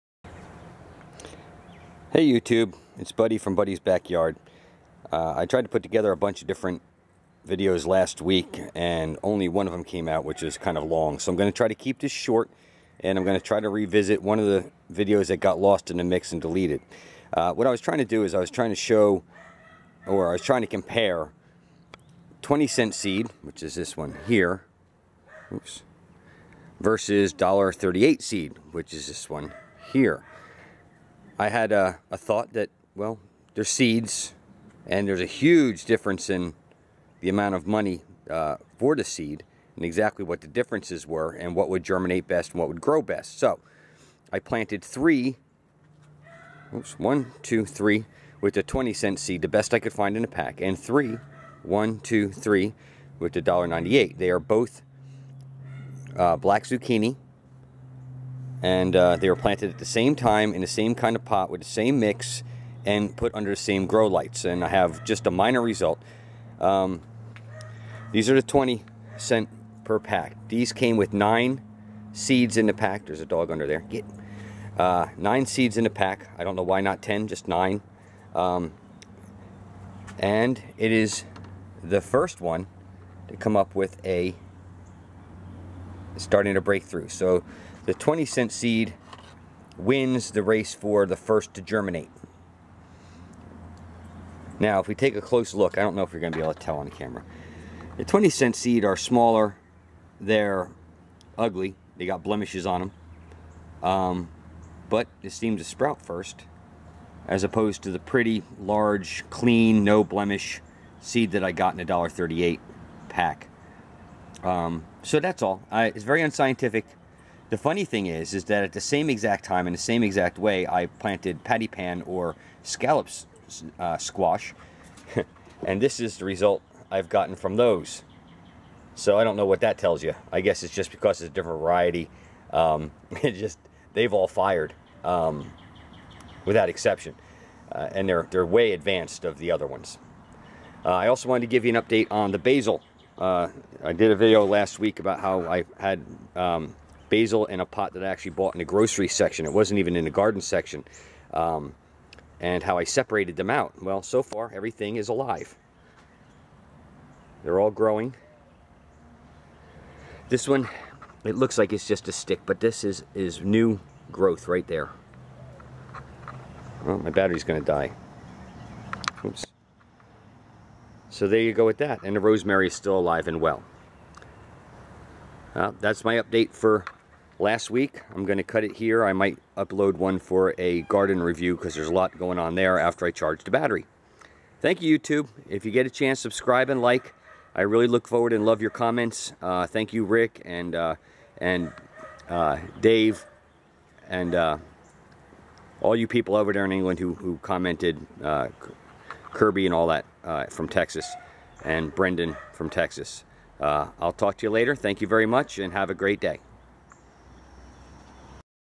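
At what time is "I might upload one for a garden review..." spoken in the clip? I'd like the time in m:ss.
2:59.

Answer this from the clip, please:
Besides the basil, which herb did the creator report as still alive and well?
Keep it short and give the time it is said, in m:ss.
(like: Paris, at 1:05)
Rosemary, at 2:52.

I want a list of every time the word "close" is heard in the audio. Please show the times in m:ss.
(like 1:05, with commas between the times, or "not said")
1:35.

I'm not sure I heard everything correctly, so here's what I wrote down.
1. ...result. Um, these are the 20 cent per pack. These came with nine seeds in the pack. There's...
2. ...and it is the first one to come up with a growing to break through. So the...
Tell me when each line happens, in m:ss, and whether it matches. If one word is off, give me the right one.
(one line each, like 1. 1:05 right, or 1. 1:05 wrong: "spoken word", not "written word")
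1. 1:05 right
2. 1:20 wrong: "starting", not "growing".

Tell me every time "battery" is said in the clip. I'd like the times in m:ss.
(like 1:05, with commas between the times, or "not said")
2:47, 3:03.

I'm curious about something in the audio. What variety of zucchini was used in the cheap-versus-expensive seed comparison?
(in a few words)
Black zucchini.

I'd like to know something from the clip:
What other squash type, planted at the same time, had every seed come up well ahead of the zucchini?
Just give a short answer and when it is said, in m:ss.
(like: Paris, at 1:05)
Patty pan, at 2:01.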